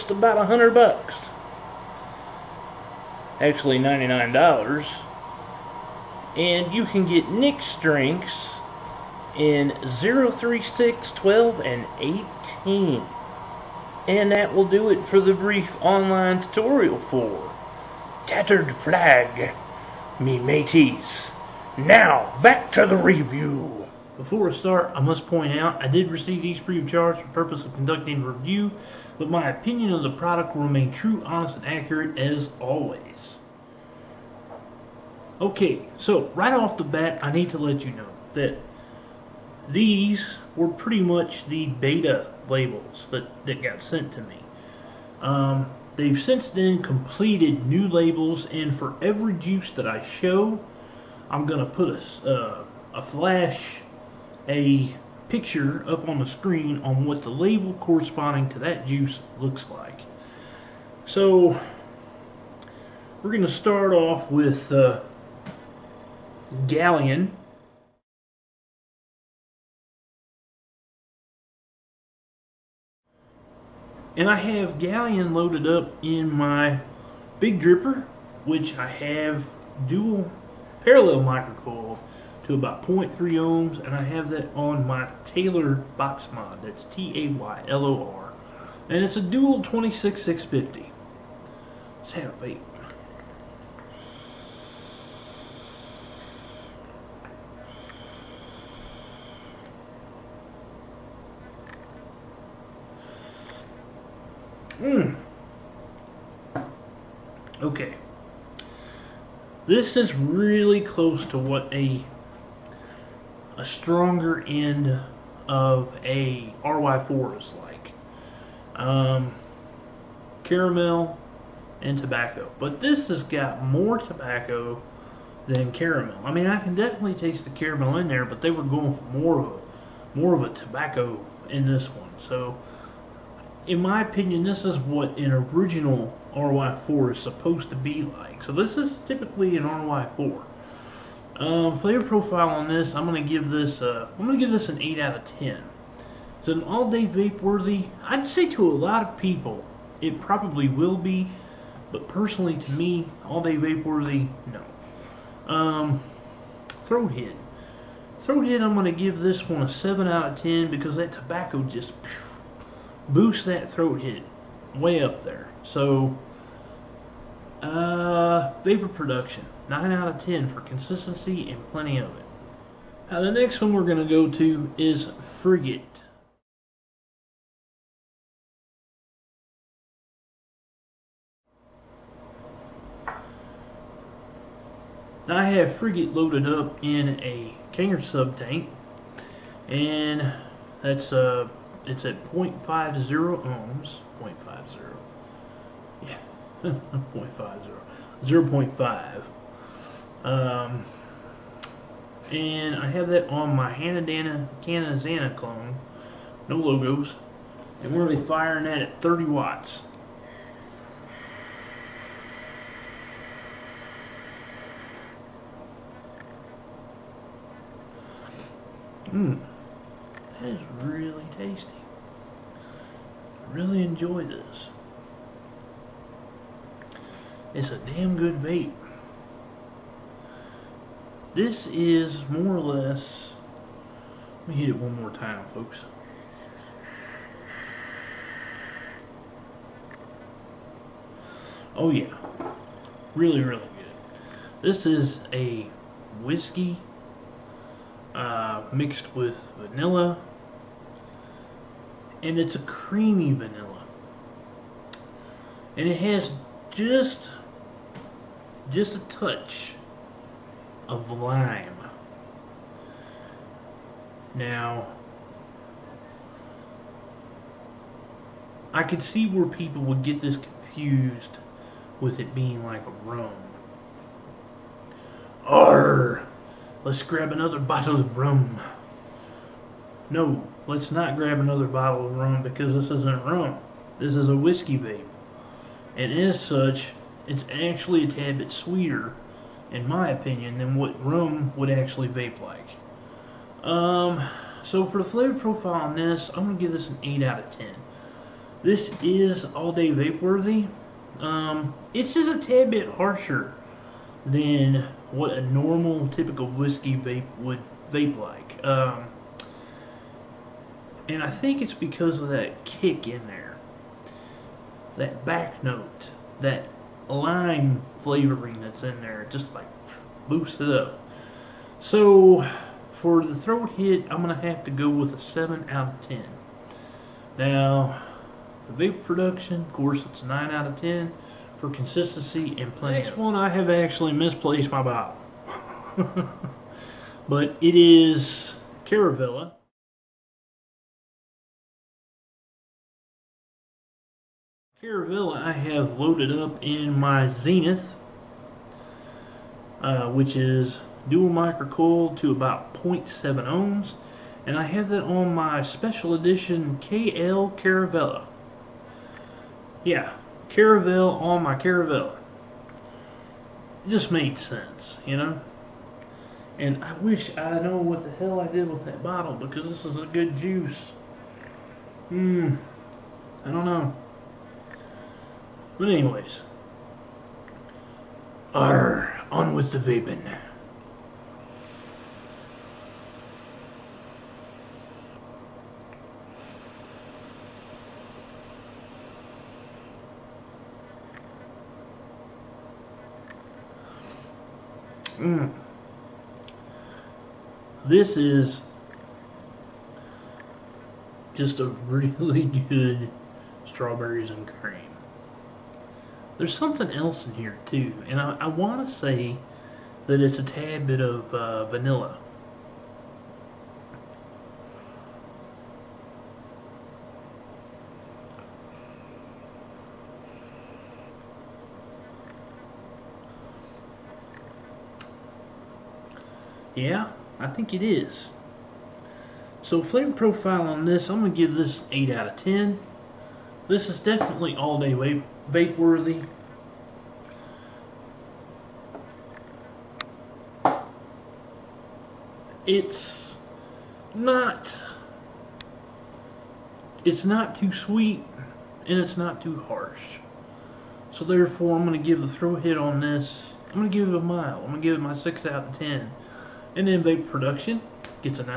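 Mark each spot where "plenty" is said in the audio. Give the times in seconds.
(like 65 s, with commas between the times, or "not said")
171 s, 332 s.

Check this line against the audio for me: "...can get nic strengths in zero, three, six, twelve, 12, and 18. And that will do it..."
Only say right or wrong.
right.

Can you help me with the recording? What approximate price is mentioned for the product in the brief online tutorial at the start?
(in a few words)
$99.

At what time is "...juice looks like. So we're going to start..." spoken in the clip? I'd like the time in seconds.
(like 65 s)
58 s.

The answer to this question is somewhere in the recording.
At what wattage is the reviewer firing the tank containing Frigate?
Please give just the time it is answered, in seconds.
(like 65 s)
209 s.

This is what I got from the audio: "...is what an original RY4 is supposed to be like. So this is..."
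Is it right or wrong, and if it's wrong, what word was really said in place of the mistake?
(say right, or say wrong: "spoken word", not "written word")
right.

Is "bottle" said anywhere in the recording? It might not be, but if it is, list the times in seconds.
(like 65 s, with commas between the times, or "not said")
277 s, 281 s, 334 s, 369 s.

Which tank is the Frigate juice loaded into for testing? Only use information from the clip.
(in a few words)
Kanger sub tank.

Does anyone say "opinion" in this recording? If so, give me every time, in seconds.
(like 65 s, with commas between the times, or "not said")
29 s, 133 s, 290 s.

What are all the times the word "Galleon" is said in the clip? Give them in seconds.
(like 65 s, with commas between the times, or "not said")
66 s, 74 s.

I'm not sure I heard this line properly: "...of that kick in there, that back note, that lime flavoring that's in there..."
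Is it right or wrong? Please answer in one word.
right.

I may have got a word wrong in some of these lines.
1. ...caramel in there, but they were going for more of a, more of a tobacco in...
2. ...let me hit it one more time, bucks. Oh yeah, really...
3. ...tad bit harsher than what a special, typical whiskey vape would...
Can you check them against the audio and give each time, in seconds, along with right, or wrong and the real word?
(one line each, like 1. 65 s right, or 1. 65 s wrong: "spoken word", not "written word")
1. 127 s right
2. 234 s wrong: "folks", not "bucks"
3. 302 s wrong: "normal", not "special".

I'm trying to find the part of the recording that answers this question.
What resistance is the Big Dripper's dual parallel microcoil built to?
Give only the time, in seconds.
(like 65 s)
82 s.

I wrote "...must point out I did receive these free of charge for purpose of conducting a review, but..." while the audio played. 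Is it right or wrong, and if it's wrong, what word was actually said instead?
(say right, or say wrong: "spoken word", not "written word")
right.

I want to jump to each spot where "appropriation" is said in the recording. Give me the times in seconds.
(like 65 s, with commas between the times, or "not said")
not said.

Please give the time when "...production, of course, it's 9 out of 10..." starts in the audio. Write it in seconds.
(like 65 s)
329 s.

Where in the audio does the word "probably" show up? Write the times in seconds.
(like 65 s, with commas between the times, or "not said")
150 s.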